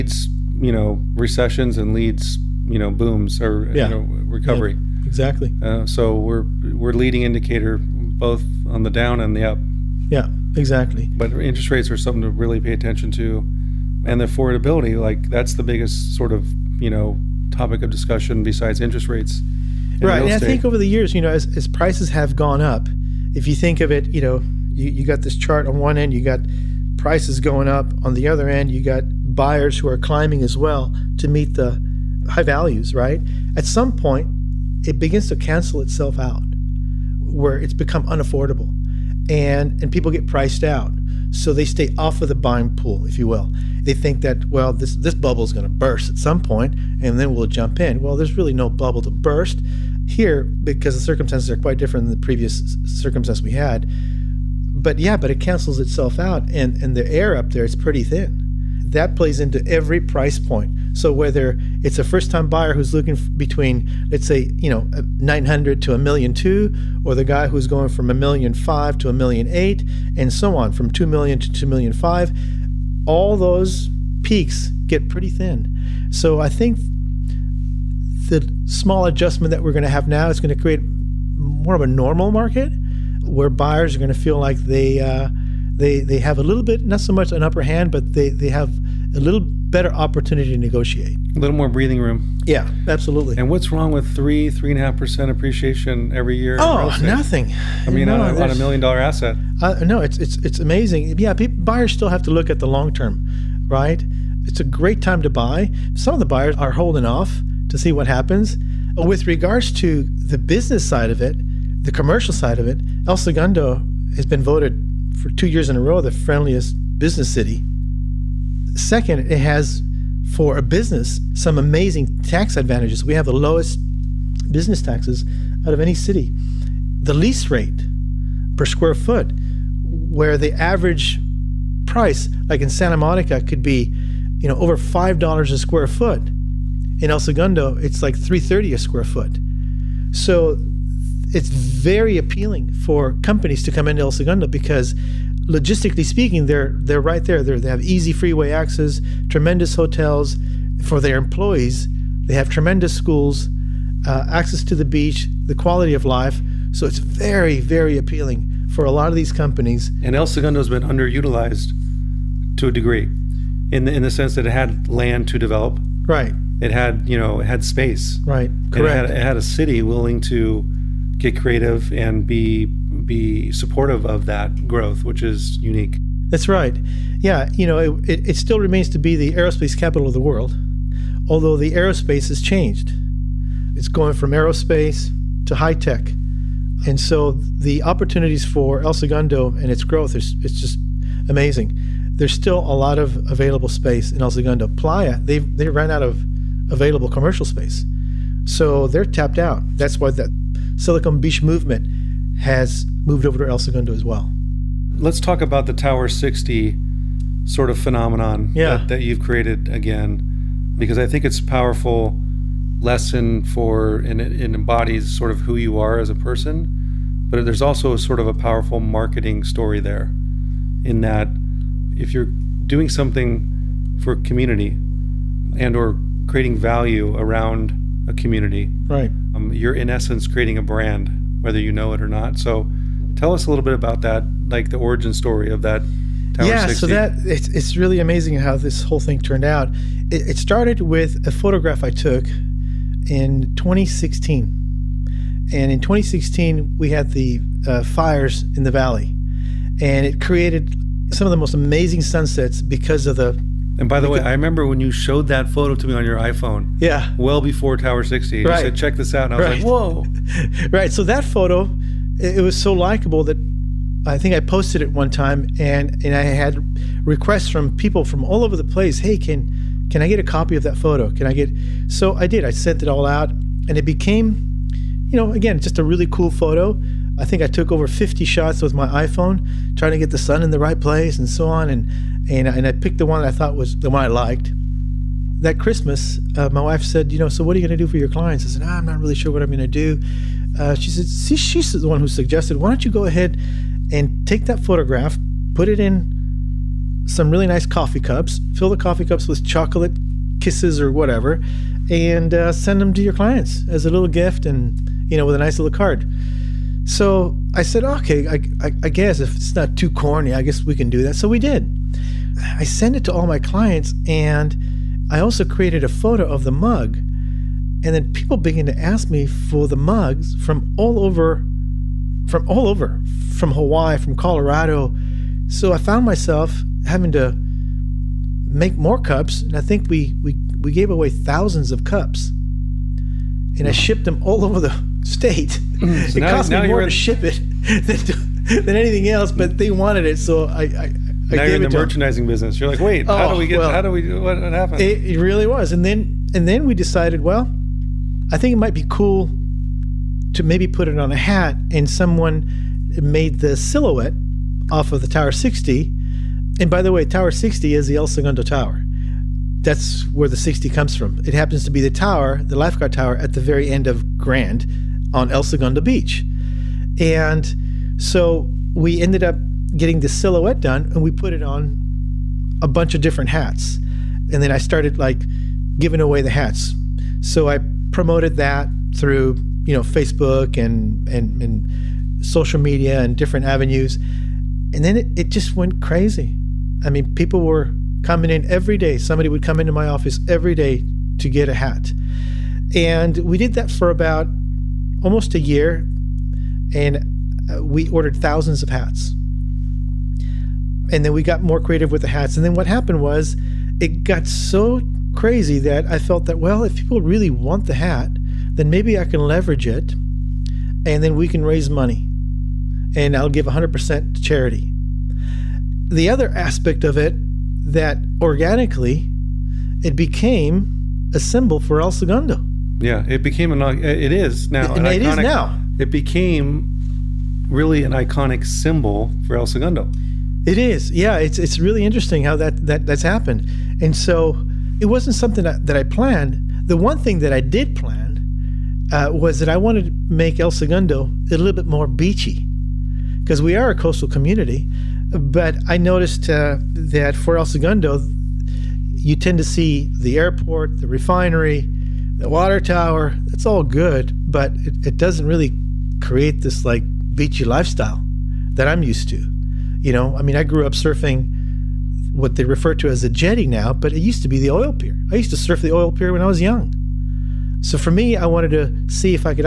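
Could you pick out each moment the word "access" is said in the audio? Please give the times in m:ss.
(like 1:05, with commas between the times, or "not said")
2:28, 2:34.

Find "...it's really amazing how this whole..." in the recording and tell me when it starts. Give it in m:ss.
3:57.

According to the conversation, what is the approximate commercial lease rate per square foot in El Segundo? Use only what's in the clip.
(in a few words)
$3.30.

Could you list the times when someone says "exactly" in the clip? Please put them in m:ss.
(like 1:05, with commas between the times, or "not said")
0:05, 0:10.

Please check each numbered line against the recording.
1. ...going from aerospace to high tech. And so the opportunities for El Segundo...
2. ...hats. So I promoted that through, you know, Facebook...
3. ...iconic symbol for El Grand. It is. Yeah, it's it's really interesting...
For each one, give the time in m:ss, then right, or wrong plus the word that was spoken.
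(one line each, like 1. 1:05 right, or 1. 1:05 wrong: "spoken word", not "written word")
1. 3:03 right
2. 6:16 right
3. 7:07 wrong: "Segundo", not "Grand".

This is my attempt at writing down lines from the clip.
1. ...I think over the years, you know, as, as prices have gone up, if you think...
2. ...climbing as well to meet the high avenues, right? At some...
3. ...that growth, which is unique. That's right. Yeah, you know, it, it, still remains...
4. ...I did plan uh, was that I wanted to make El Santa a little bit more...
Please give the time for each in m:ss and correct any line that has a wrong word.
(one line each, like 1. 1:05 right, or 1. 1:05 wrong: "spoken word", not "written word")
1. 0:20 right
2. 0:29 wrong: "values", not "avenues"
3. 2:54 right
4. 7:17 wrong: "Segundo", not "Santa".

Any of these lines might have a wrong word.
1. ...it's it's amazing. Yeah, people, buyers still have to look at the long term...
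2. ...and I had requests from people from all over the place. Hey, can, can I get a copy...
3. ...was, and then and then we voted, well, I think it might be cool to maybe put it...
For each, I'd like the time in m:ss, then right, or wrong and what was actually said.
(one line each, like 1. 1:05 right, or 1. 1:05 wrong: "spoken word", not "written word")
1. 1:40 right
2. 4:26 right
3. 5:45 wrong: "decided", not "voted".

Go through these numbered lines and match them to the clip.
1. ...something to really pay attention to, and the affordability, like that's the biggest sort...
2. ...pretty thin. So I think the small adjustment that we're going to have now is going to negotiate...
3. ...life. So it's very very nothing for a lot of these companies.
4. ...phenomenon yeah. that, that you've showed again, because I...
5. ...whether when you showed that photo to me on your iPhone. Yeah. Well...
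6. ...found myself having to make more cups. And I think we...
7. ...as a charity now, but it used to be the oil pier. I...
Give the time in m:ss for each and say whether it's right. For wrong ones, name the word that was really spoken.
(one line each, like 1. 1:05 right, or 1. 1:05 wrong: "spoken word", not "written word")
1. 0:11 right
2. 1:15 wrong: "create", not "negotiate"
3. 2:36 wrong: "appealing", not "nothing"
4. 3:27 wrong: "created", not "showed"
5. 4:14 wrong: "remember", not "whether"
6. 5:25 right
7. 7:42 wrong: "jetty", not "charity".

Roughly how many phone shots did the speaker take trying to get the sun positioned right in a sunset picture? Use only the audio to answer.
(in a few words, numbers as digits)
50.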